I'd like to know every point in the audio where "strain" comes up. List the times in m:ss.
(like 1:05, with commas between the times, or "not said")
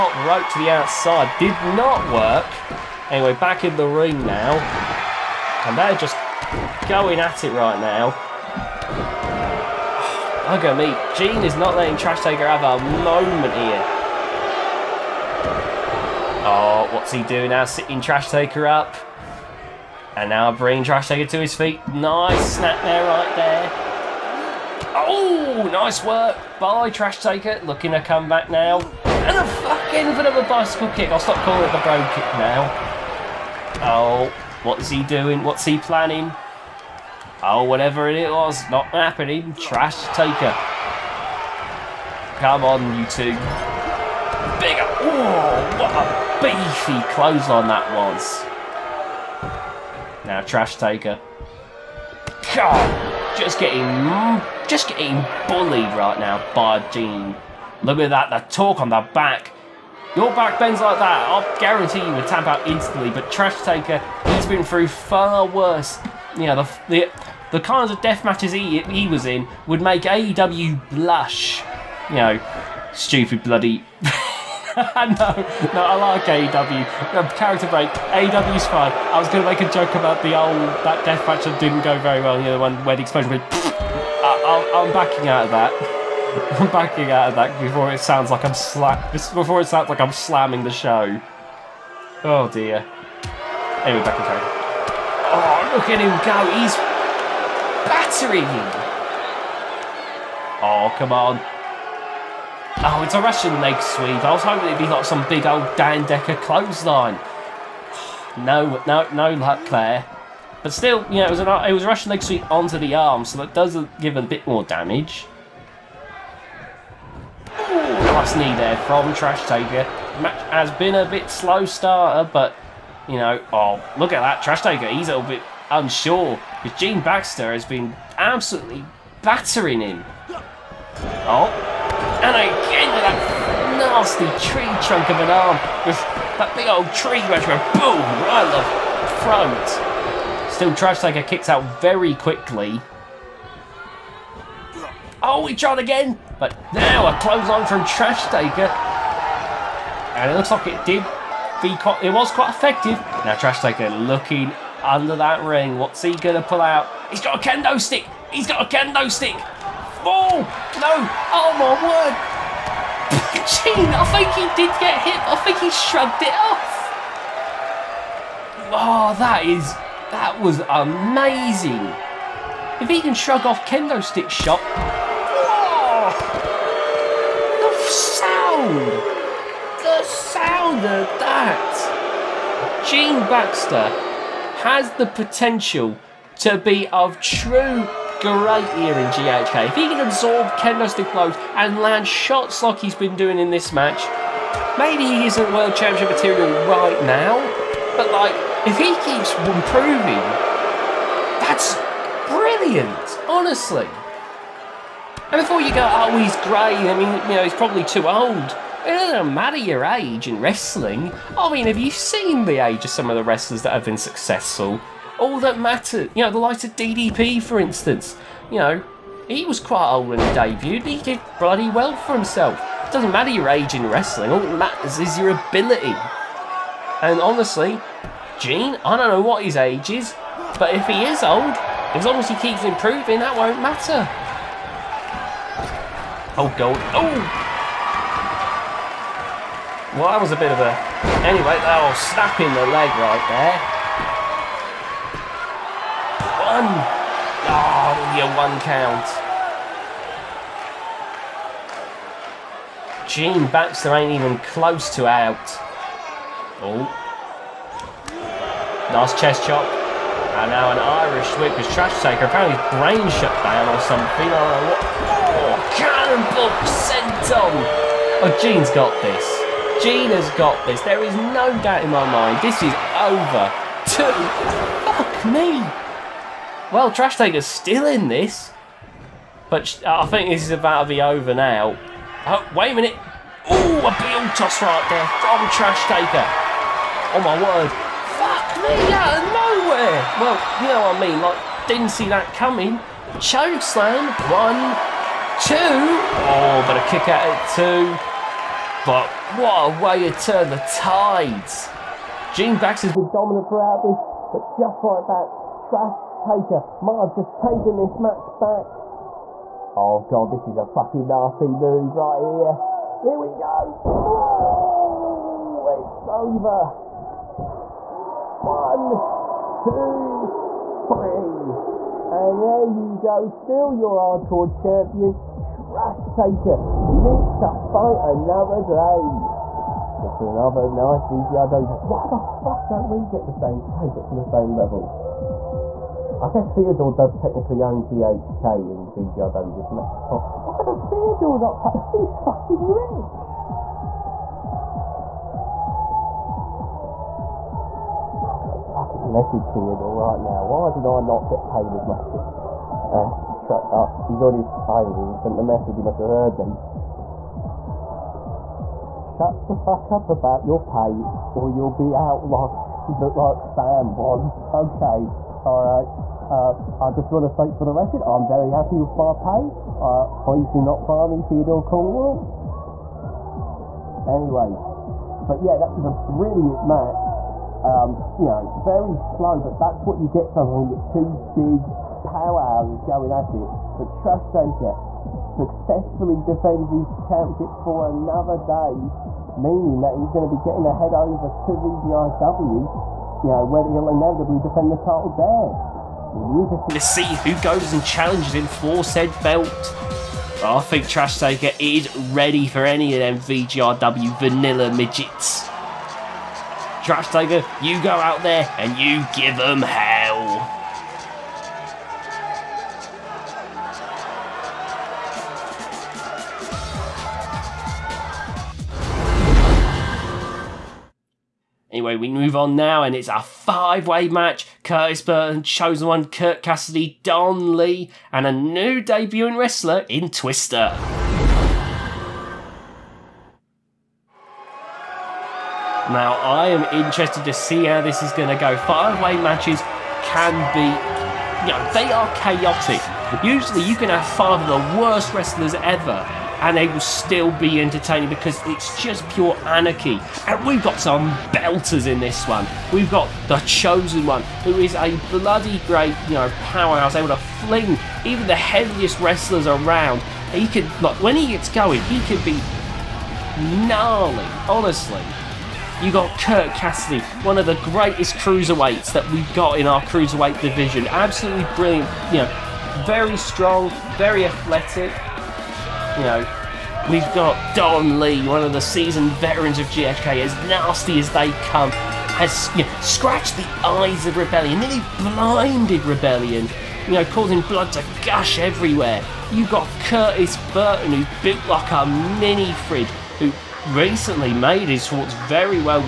not said.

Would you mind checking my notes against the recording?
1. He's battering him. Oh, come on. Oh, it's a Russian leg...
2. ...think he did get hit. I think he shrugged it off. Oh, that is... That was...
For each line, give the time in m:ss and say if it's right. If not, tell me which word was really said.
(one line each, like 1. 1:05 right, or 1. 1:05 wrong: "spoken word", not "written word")
1. 1:36 right
2. 2:44 right.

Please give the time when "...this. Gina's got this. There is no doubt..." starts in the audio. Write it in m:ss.
4:29.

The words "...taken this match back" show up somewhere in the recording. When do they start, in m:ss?
5:07.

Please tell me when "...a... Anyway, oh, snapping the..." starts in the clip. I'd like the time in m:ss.
4:00.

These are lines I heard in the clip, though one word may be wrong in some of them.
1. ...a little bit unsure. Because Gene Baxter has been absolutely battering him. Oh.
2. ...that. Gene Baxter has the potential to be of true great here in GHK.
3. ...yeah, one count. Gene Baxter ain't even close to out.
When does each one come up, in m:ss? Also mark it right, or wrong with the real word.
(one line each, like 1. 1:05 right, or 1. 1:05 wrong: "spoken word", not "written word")
1. 2:05 right
2. 3:01 right
3. 4:08 right.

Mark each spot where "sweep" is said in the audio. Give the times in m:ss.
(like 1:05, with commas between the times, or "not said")
1:43, 1:52.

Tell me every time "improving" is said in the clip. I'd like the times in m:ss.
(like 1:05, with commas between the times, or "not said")
3:19, 3:52.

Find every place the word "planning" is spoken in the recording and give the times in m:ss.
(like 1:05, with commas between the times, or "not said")
0:35.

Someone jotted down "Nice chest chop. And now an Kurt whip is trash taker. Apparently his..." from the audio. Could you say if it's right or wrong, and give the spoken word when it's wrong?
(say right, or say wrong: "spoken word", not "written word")
wrong: "Irish", not "Kurt".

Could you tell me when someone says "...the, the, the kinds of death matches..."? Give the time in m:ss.
1:06.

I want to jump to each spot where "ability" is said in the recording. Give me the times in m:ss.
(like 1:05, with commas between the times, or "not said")
3:45.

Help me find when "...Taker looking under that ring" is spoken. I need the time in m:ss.
2:33.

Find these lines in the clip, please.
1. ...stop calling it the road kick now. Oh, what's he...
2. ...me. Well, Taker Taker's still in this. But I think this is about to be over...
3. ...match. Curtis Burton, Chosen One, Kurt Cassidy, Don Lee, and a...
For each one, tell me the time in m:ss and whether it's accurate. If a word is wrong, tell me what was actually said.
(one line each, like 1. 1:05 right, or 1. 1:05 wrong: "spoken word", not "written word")
1. 0:31 right
2. 4:35 wrong: "Trash", not "Taker"
3. 7:04 right.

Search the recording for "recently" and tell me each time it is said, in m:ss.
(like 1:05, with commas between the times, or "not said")
8:13.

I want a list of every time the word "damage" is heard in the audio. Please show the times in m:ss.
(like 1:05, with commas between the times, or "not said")
1:54.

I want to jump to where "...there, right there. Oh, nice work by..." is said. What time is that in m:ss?
0:22.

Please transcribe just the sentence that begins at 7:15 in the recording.
Now, I am interested to see how this is going to go.